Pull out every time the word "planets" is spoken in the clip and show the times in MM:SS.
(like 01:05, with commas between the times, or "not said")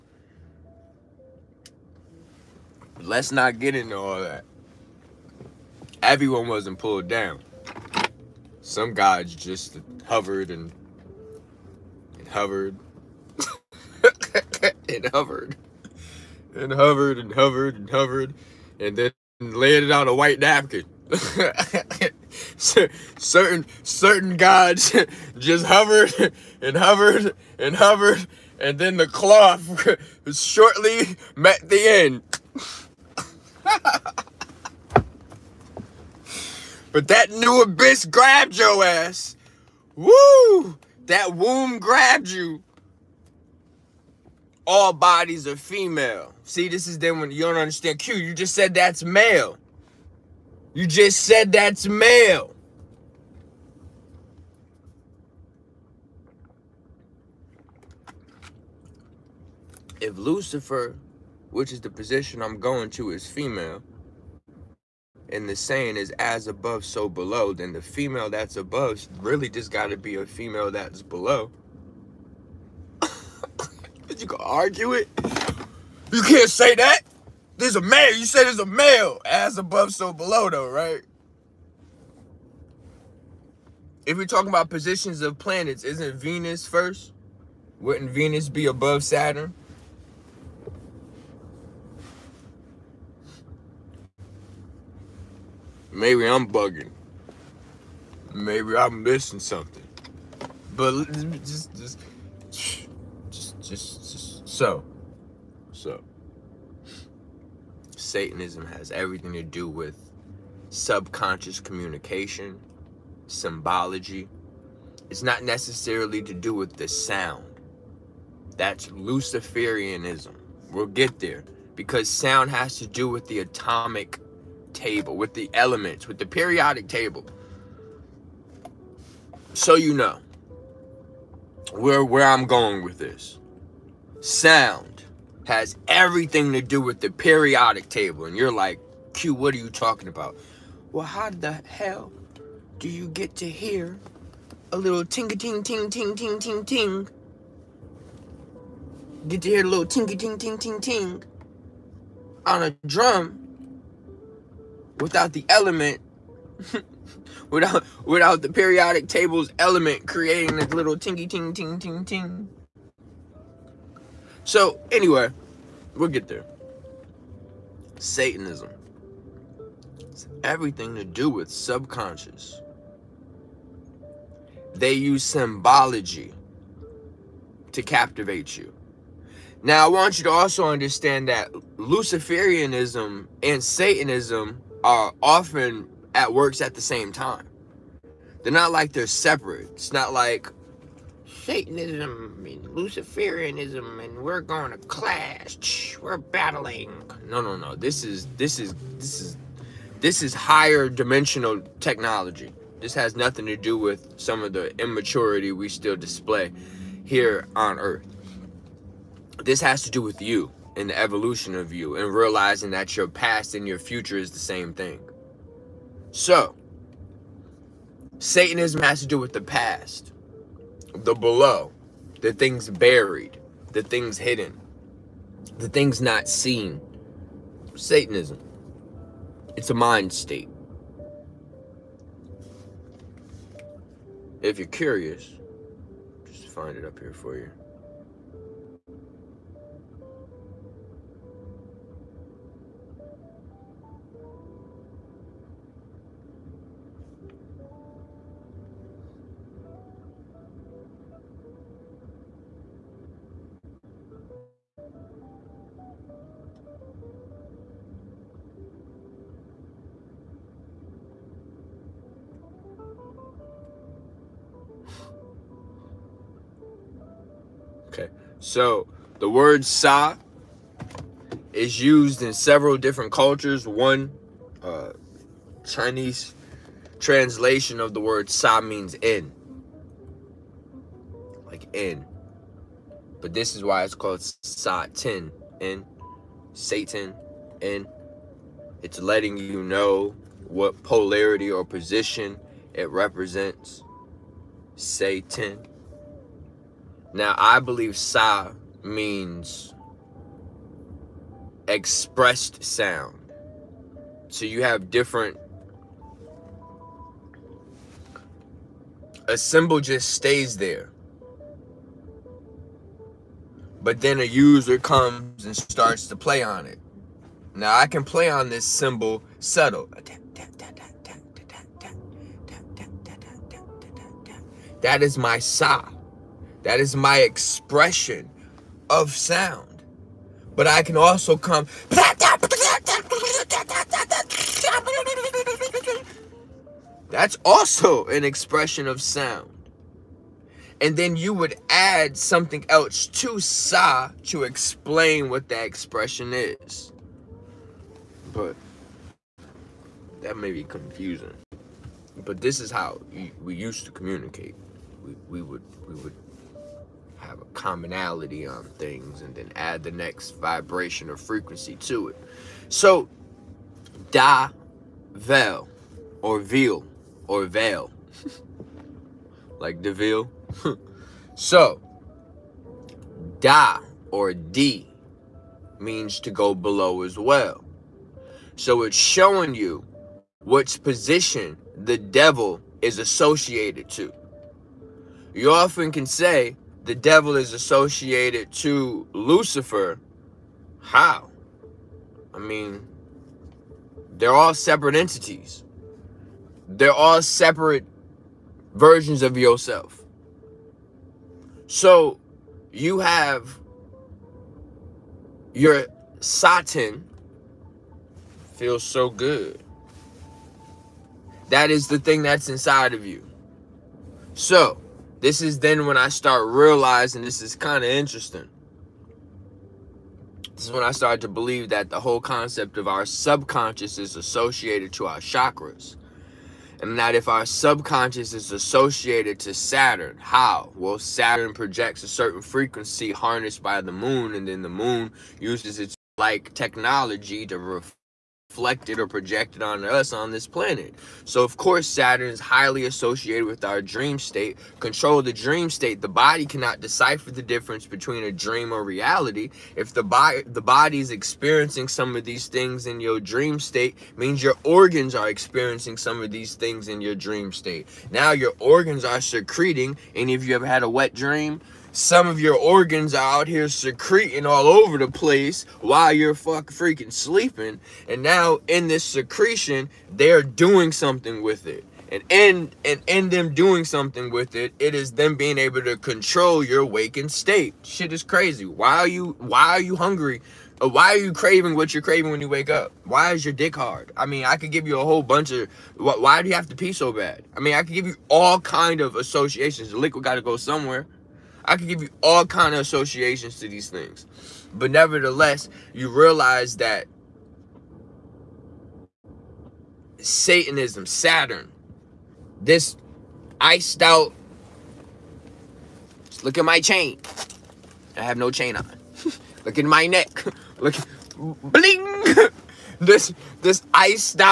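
01:25, 07:20.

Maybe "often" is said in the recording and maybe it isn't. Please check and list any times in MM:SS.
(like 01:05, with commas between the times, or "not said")
03:05, 06:25.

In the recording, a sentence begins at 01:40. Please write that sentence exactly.
But just, just, just, just, just so, so.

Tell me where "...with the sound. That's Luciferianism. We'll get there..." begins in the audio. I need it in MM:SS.
01:56.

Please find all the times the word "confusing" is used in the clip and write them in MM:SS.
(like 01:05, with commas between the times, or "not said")
05:50.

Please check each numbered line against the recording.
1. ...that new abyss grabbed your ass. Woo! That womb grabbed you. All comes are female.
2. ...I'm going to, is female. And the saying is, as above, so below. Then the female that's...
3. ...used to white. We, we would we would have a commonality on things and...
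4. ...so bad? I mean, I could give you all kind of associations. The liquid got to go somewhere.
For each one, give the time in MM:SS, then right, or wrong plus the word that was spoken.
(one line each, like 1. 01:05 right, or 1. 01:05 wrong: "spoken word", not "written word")
1. 00:37 wrong: "bodies", not "comes"
2. 01:02 right
3. 05:53 wrong: "communicate", not "white"
4. 08:06 right.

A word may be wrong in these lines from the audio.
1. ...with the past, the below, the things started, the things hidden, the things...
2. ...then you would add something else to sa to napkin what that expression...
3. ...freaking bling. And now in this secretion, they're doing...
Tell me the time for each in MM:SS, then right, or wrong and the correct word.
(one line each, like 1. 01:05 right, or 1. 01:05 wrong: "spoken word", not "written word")
1. 03:39 wrong: "buried", not "started"
2. 05:40 wrong: "explain", not "napkin"
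3. 07:46 wrong: "sleeping", not "bling".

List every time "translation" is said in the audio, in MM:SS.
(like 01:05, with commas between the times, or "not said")
04:36.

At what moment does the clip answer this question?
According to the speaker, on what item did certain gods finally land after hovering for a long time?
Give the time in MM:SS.
00:20.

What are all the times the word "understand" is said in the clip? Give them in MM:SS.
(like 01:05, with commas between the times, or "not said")
00:47, 03:00.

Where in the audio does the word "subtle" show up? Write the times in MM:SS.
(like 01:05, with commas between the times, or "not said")
05:19.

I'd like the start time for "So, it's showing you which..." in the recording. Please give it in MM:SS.
06:18.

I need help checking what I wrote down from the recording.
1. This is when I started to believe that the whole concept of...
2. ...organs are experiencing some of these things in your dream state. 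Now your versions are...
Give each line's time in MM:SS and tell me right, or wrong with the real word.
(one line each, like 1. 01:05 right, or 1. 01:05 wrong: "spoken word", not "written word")
1. 07:00 right
2. 07:34 wrong: "organs", not "versions".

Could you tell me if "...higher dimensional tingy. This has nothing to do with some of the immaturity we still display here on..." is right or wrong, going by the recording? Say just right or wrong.
wrong.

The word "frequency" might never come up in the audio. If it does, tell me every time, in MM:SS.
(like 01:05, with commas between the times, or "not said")
06:01, 07:12.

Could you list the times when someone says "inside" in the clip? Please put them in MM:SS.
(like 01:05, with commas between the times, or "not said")
06:52.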